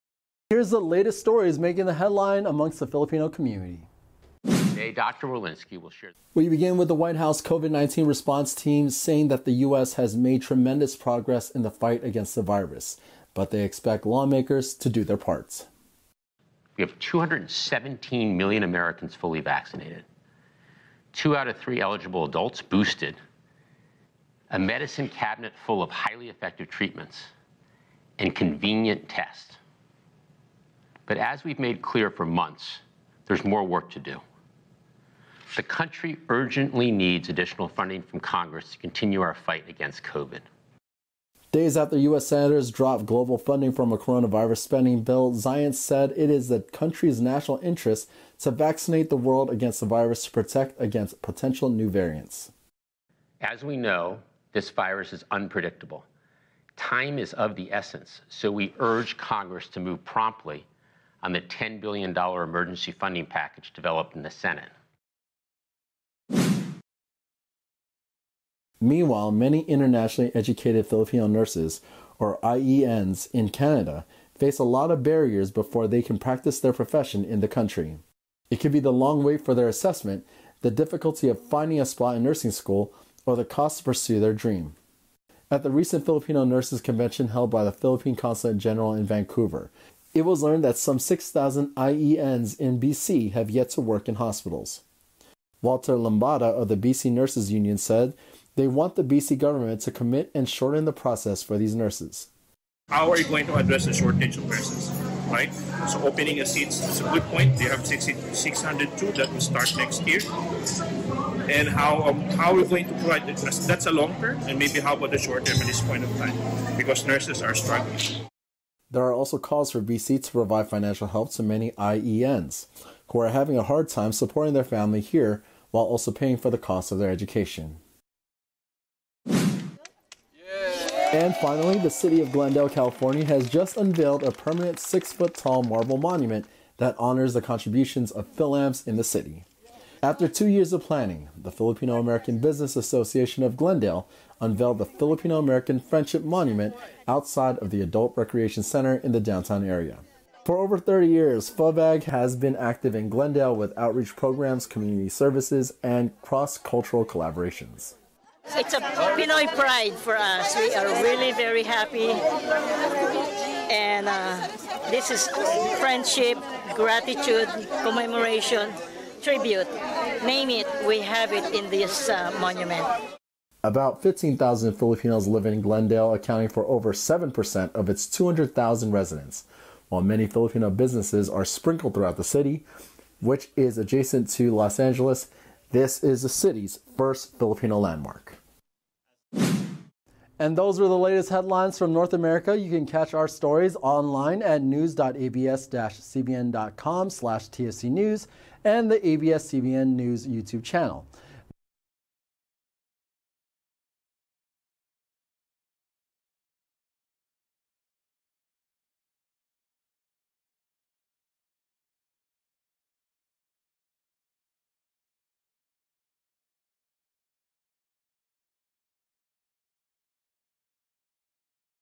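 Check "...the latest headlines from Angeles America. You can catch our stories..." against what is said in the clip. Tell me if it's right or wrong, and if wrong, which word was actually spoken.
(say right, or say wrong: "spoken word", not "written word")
wrong: "North", not "Angeles".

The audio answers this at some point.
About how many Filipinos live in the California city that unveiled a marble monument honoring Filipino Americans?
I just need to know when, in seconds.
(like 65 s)
174 s.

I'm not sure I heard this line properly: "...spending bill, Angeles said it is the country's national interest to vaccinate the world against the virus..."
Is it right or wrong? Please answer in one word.
wrong.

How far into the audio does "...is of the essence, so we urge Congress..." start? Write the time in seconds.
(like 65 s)
57 s.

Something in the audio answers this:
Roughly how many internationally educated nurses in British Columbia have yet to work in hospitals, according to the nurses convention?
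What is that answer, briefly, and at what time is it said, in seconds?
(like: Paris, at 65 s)
6,000, at 90 s.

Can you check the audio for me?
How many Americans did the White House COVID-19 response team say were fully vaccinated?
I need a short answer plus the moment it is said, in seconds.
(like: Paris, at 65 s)
217 million, at 16 s.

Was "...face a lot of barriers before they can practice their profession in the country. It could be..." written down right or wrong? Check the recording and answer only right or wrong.
right.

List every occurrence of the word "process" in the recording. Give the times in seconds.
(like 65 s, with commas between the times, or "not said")
100 s.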